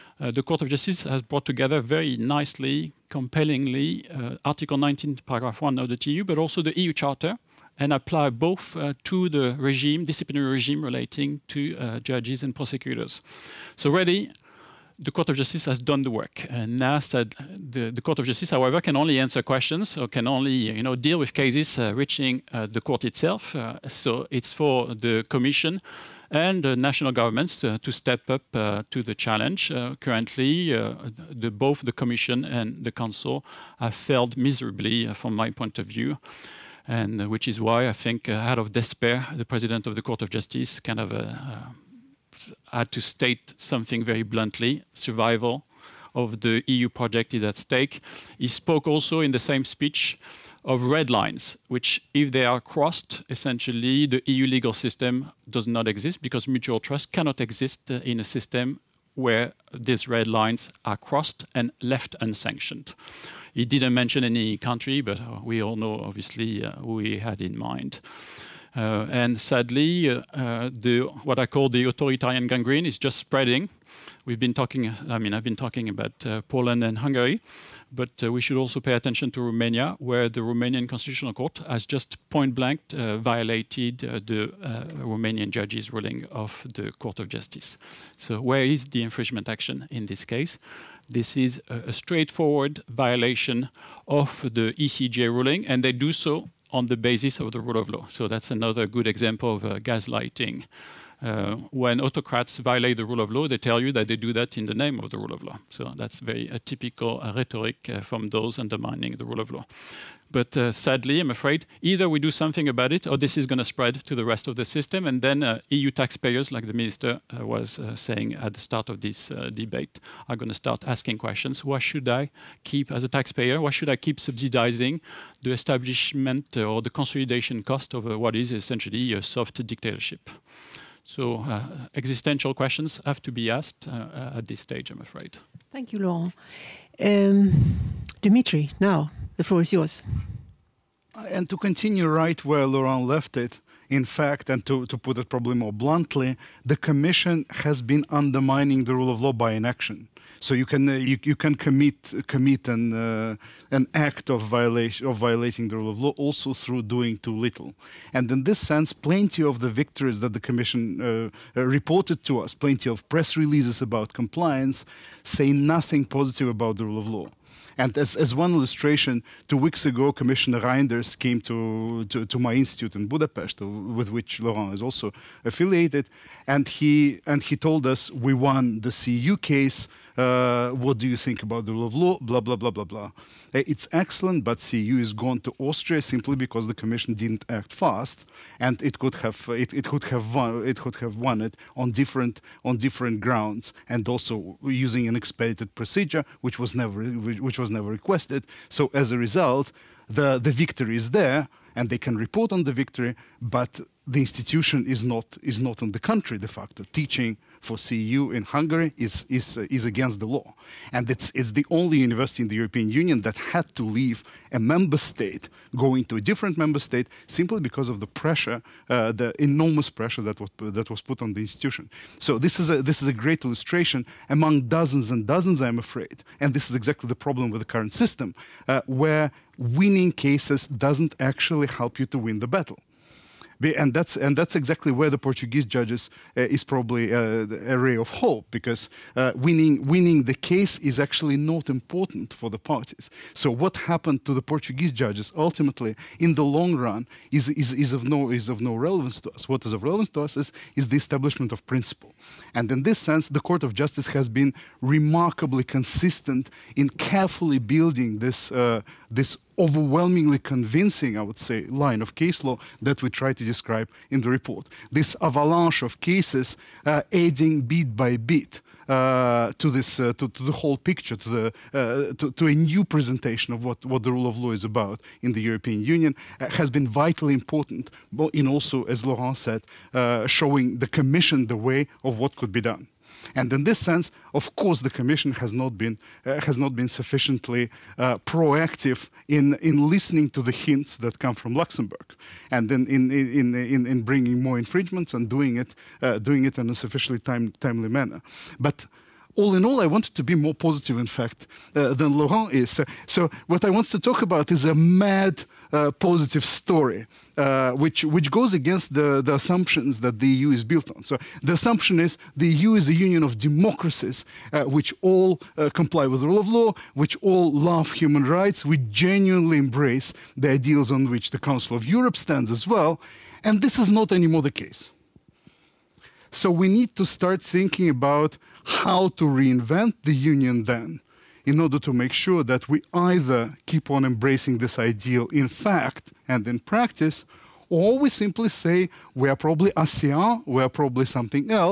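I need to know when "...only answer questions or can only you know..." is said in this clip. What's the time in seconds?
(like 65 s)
18 s.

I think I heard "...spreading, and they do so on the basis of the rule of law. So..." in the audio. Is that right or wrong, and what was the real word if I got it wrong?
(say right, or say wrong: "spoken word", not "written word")
wrong: "ruling", not "spreading".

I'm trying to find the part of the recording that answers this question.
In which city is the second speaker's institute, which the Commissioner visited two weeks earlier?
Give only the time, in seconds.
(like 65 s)
173 s.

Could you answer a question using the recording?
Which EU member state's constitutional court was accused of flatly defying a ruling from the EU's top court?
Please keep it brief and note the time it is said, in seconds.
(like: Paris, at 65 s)
Romania, at 79 s.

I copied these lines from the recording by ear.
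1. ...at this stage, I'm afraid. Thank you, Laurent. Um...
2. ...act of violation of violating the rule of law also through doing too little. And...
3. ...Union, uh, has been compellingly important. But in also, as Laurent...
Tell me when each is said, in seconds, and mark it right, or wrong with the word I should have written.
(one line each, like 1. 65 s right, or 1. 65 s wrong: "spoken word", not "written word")
1. 134 s right
2. 153 s right
3. 275 s wrong: "vitally", not "compellingly".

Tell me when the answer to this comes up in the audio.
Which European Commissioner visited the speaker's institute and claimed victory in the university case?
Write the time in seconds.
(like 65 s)
170 s.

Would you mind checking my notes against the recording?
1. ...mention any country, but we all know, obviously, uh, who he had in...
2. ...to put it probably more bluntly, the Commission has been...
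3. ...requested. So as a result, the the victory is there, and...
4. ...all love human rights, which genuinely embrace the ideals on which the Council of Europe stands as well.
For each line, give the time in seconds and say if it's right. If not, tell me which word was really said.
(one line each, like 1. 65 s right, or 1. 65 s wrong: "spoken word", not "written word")
1. 63 s right
2. 144 s right
3. 197 s right
4. 317 s right.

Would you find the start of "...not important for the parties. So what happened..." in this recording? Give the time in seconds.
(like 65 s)
241 s.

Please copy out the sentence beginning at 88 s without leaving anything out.
So, where is the infringement action in this case?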